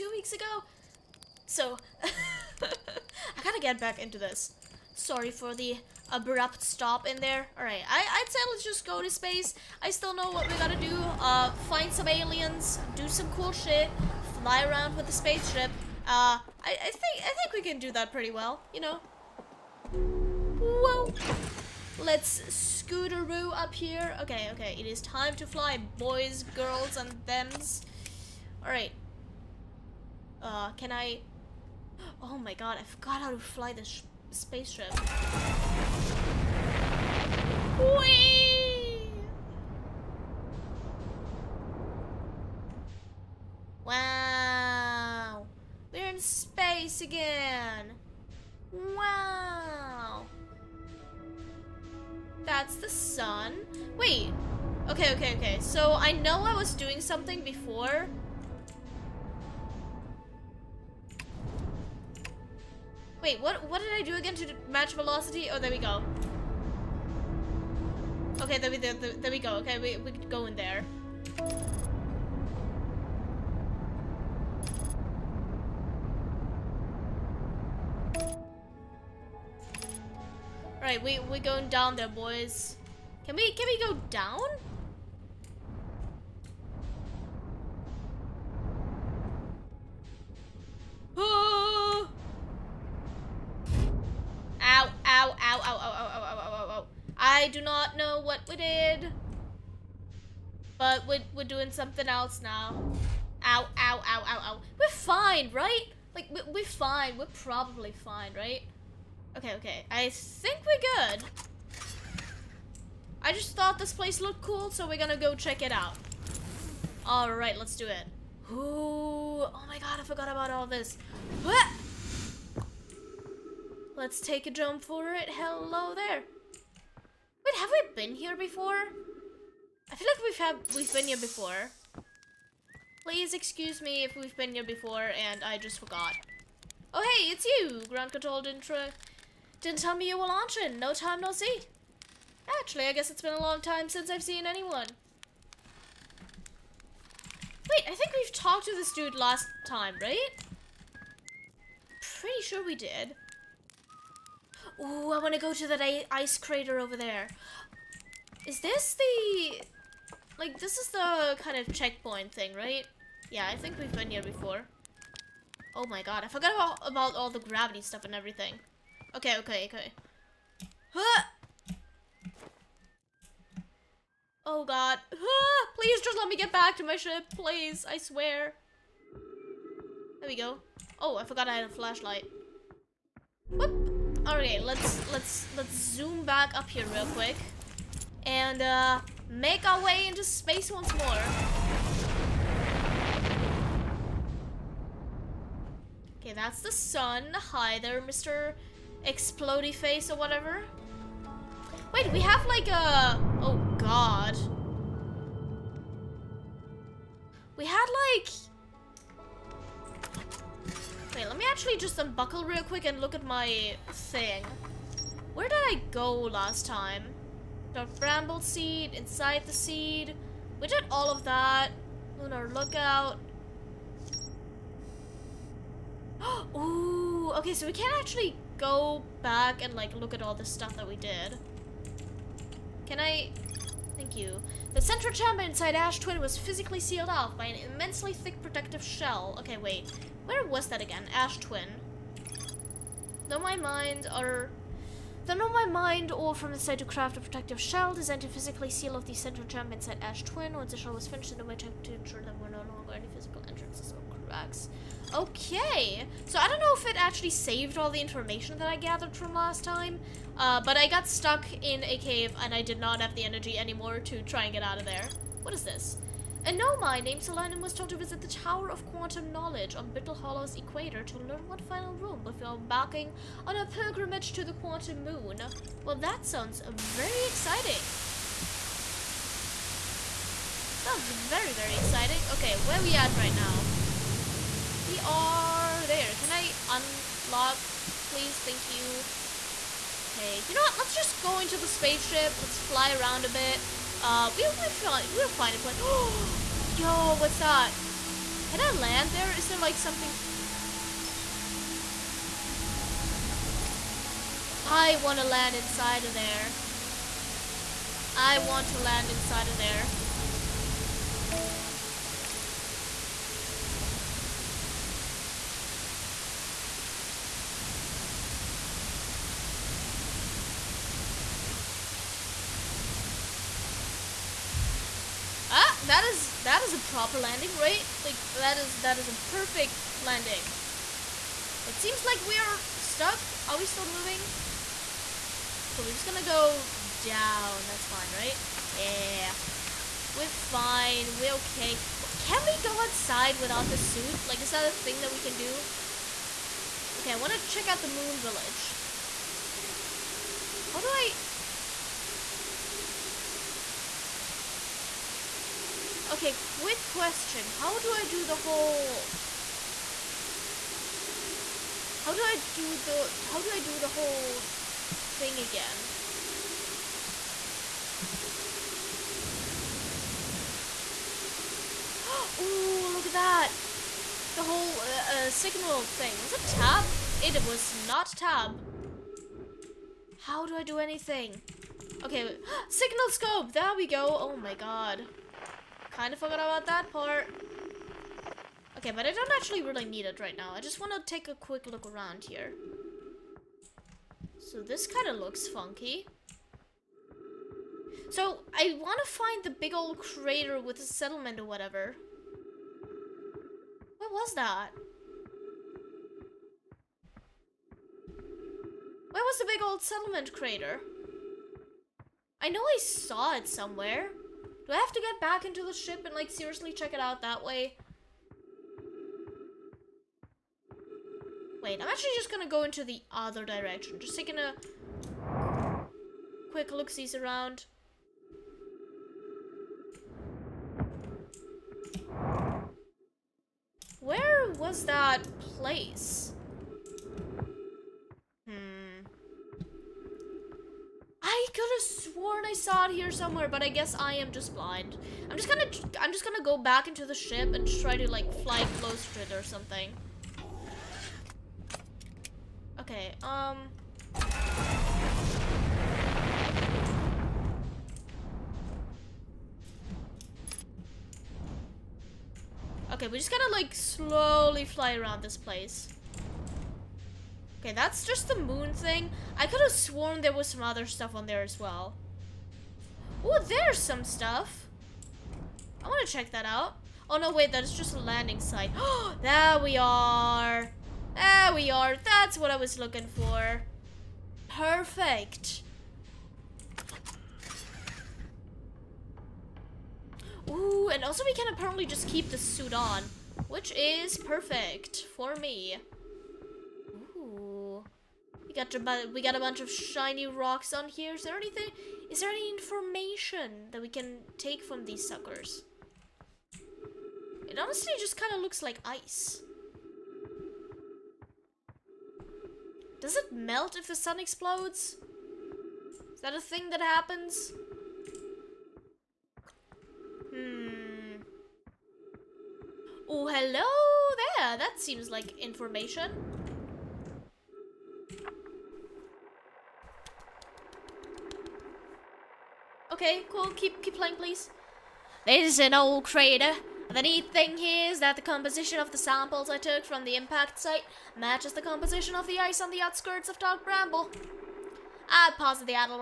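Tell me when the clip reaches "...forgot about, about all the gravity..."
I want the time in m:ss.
2:46.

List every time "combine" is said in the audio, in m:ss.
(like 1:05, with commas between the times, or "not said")
not said.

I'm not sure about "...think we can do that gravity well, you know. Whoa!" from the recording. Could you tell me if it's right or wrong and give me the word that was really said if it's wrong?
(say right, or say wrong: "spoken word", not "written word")
wrong: "pretty", not "gravity".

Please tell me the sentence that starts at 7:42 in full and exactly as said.
Okay, we just gotta like slowly fly around this place.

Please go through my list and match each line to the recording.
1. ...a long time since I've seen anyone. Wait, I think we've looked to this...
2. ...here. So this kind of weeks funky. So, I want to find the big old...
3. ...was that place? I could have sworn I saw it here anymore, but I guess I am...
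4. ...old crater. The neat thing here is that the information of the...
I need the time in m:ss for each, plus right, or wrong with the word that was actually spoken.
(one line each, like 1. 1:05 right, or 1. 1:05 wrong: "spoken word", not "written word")
1. 2:23 wrong: "talked", not "looked"
2. 6:32 wrong: "looks", not "weeks"
3. 7:14 wrong: "somewhere", not "anymore"
4. 8:55 wrong: "composition", not "information".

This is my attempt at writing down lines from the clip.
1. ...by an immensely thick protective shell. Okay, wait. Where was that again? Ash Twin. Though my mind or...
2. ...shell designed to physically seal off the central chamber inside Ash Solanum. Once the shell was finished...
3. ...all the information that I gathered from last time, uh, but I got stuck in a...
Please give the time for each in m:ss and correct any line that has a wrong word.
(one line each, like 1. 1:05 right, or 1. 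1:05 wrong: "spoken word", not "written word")
1. 3:57 right
2. 4:07 wrong: "Twin", not "Solanum"
3. 4:17 right.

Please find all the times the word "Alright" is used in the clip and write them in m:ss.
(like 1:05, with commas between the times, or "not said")
0:07, 0:28, 1:57.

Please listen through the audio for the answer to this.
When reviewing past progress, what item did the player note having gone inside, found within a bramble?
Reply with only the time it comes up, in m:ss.
3:37.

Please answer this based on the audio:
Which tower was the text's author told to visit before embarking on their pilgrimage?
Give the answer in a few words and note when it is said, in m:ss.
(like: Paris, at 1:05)
Tower of Quantum Knowledge, at 4:28.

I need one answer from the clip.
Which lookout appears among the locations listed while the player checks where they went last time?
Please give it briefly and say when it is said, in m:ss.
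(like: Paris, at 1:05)
Lunar lookout, at 3:42.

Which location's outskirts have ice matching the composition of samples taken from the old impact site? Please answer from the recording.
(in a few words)
Dark Bramble.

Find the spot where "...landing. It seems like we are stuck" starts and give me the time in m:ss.
5:30.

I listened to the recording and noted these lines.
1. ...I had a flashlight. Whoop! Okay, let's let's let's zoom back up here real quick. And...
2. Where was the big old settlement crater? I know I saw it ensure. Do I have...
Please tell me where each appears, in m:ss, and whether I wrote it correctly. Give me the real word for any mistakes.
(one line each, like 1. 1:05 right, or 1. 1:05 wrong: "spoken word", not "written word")
1. 3:01 right
2. 6:49 wrong: "somewhere", not "ensure".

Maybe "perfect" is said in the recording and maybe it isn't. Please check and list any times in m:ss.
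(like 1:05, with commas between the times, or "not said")
5:29, 8:04, 8:14.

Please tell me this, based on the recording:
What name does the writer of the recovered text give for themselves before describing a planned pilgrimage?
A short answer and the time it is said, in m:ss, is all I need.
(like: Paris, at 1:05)
Solanum, at 4:27.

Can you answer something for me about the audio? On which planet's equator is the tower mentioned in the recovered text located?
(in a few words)
Brittle Hollow.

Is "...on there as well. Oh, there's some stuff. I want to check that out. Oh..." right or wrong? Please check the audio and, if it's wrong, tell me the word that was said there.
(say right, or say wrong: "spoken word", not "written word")
right.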